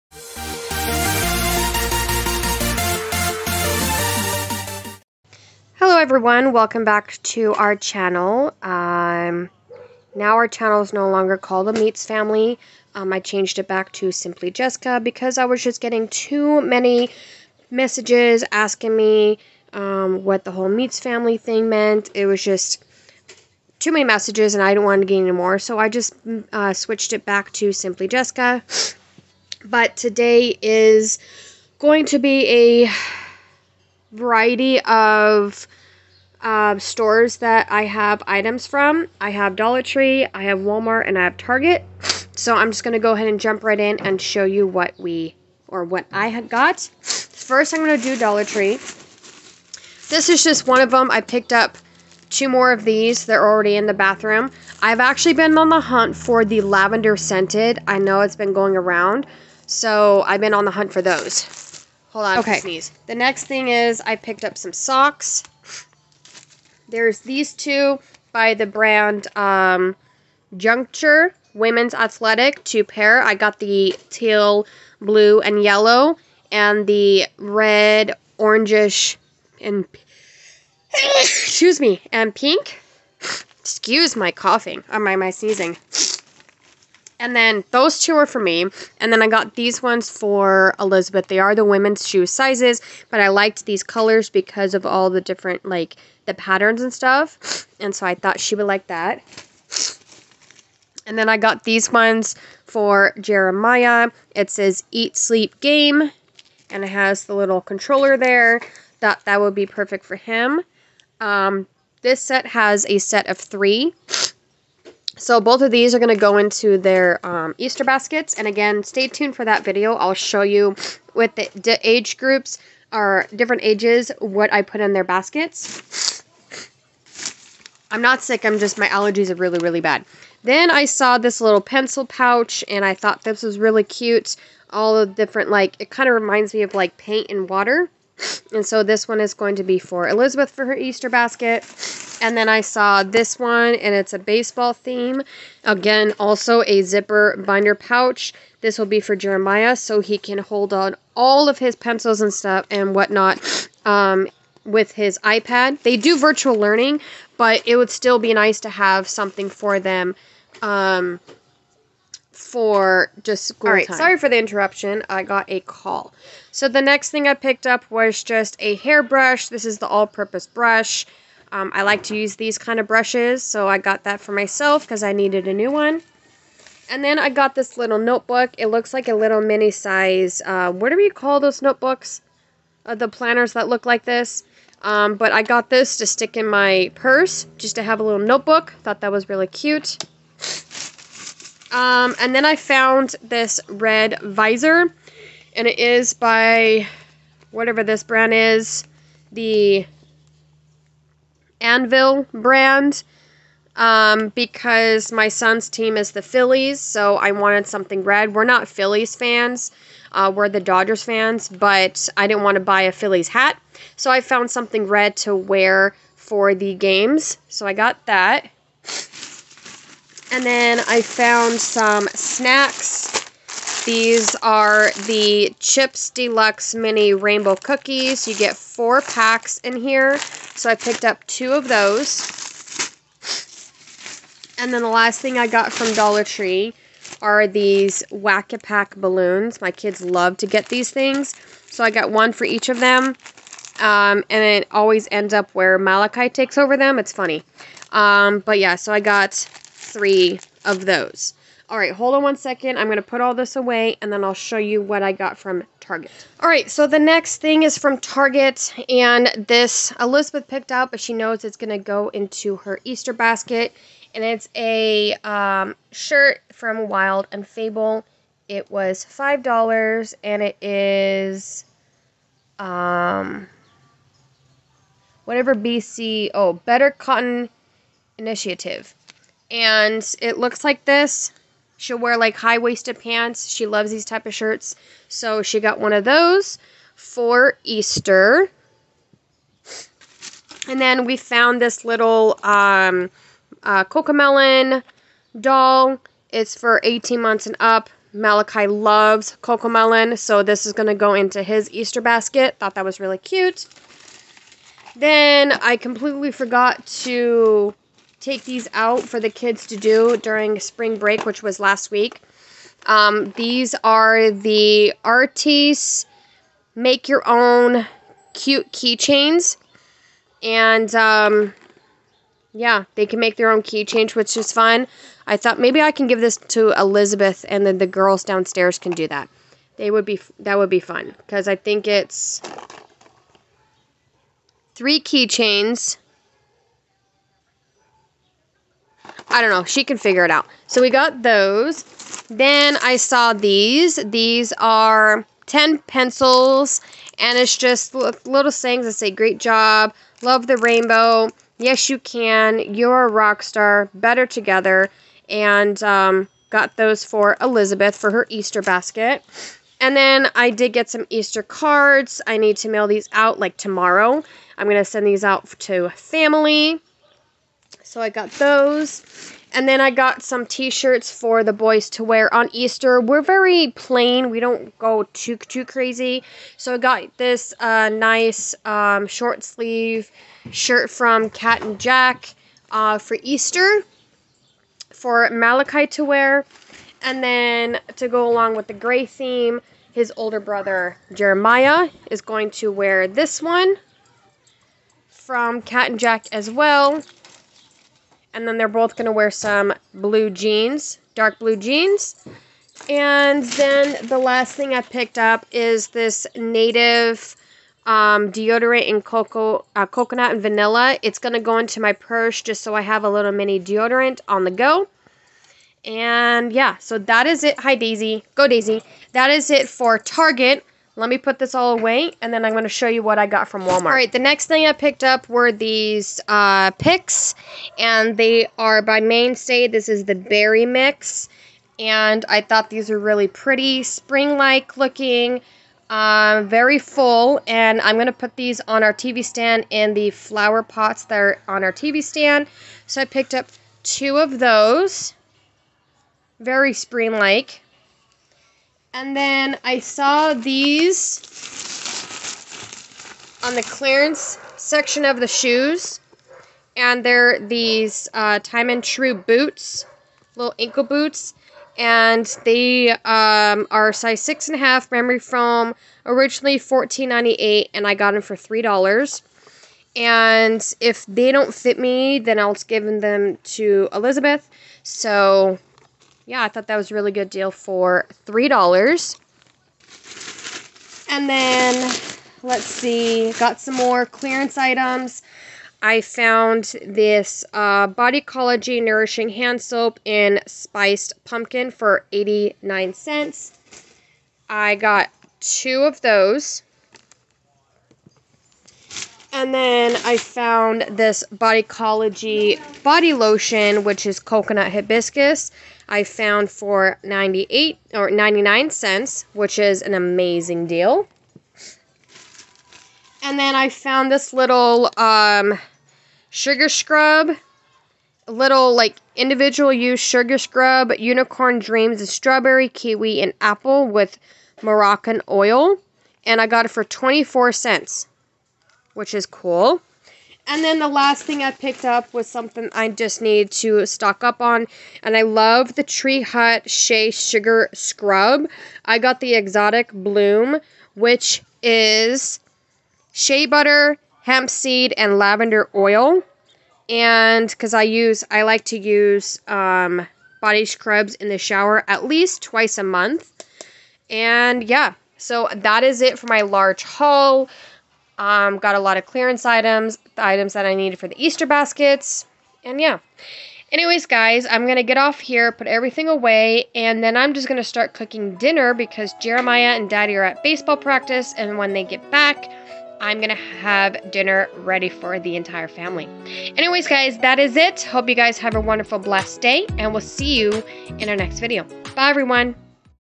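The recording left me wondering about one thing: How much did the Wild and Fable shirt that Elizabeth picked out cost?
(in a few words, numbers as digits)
$5.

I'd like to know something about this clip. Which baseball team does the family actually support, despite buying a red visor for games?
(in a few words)
Dodgers.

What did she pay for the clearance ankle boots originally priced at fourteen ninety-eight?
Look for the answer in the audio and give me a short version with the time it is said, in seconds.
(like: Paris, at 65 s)
$3, at 468 s.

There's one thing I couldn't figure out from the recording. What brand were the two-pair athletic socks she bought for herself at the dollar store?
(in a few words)
Juncture.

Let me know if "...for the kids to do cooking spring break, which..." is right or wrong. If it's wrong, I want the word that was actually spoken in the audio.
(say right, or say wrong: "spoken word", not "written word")
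wrong: "during", not "cooking".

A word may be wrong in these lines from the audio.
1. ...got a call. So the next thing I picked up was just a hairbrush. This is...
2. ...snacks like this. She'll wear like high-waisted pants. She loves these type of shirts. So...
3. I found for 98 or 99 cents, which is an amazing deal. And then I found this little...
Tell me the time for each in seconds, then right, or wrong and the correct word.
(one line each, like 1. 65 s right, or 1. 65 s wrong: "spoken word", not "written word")
1. 165 s right
2. 280 s wrong: "looks", not "snacks"
3. 505 s right.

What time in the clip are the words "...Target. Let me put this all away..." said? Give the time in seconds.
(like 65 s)
419 s.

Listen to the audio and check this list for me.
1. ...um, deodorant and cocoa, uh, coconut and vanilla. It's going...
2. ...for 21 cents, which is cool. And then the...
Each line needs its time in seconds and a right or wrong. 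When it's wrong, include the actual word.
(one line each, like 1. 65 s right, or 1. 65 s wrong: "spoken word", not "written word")
1. 407 s right
2. 526 s wrong: "24", not "21".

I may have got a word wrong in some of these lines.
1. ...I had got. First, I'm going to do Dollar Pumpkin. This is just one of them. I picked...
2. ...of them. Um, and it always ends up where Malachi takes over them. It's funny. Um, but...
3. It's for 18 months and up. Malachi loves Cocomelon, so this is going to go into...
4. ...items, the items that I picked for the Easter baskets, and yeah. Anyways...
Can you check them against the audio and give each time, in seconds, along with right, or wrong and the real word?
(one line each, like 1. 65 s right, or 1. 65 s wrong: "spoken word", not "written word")
1. 46 s wrong: "Tree", not "Pumpkin"
2. 242 s right
3. 296 s right
4. 559 s wrong: "needed", not "picked".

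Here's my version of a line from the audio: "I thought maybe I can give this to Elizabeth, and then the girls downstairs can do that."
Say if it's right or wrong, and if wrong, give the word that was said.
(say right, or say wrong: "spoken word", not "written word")
right.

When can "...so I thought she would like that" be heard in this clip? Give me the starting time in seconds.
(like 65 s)
97 s.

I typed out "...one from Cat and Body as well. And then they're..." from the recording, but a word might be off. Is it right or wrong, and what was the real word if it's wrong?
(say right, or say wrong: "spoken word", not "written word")
wrong: "Jack", not "Body".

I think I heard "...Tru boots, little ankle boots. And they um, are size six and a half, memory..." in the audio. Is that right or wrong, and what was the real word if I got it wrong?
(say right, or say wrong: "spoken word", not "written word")
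right.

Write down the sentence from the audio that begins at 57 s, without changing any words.
I know it's been going around.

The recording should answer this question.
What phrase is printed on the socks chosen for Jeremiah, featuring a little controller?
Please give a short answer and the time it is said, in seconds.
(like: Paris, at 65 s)
Eat, Sleep, Game, at 104 s.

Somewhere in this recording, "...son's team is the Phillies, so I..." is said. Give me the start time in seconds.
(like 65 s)
205 s.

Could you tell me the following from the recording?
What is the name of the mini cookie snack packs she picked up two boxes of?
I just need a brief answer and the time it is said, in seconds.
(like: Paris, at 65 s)
Chips Deluxe Mini Rainbow Cookies, at 225 s.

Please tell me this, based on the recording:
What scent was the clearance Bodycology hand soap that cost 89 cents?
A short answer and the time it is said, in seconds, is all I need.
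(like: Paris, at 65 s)
Spiced Pumpkin, at 490 s.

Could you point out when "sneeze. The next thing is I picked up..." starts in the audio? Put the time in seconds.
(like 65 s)
62 s.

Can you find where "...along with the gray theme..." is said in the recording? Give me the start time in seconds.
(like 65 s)
388 s.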